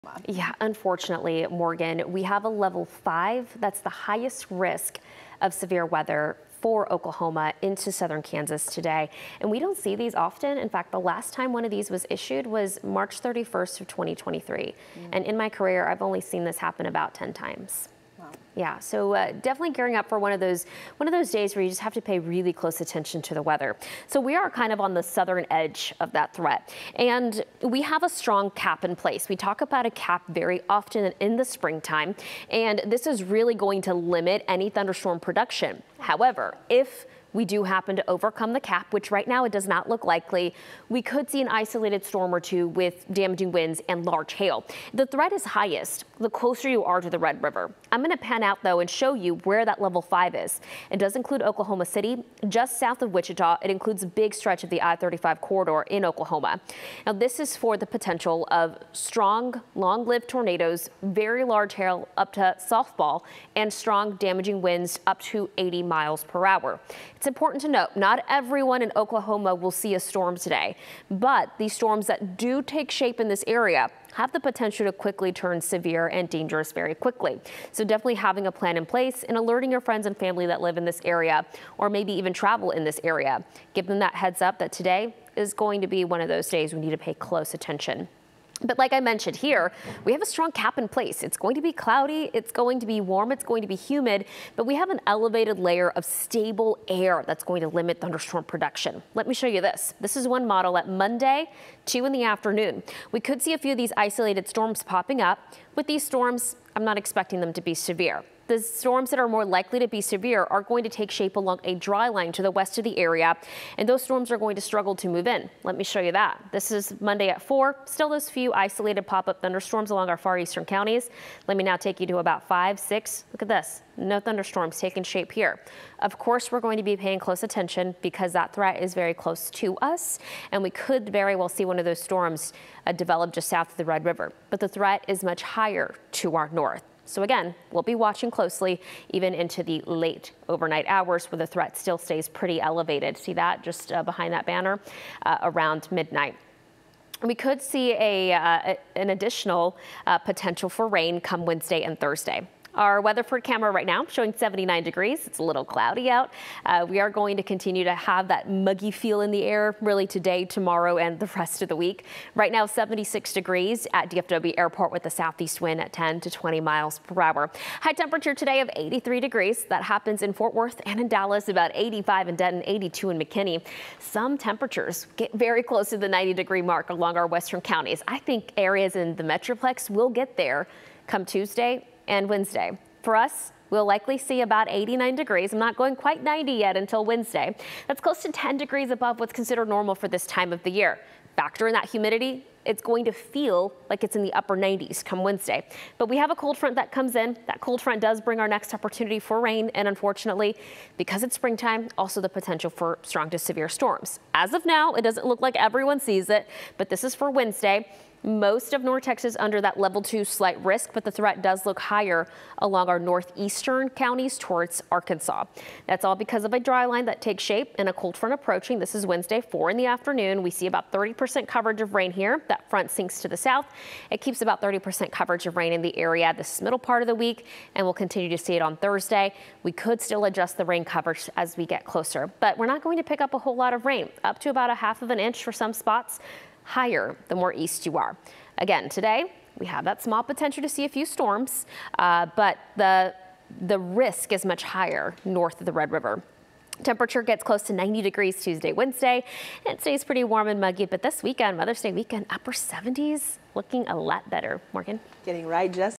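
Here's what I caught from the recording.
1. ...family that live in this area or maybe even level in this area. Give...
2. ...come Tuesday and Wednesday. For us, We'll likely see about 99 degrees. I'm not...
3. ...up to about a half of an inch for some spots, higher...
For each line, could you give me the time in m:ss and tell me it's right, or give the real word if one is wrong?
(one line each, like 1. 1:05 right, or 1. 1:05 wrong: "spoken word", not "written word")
1. 1:20 wrong: "travel", not "level"
2. 3:01 wrong: "89", not "99"
3. 3:54 right.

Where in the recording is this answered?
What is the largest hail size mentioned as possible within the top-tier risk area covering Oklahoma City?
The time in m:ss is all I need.
1:02.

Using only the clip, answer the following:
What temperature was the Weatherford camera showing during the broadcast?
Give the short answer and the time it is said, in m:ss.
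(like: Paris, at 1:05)
79 degrees, at 2:34.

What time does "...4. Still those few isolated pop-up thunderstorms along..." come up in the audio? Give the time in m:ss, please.
1:57.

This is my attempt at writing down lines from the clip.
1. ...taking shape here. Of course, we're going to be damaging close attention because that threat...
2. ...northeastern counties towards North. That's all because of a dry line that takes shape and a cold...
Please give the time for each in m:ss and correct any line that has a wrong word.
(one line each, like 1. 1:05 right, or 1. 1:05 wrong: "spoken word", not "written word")
1. 2:04 wrong: "paying", not "damaging"
2. 3:32 wrong: "Arkansas", not "North".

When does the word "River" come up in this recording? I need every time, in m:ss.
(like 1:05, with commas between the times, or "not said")
0:47, 2:14, 4:05.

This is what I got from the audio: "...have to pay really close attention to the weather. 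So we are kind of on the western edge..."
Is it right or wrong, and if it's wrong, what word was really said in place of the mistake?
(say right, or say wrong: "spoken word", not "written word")
wrong: "southern", not "western".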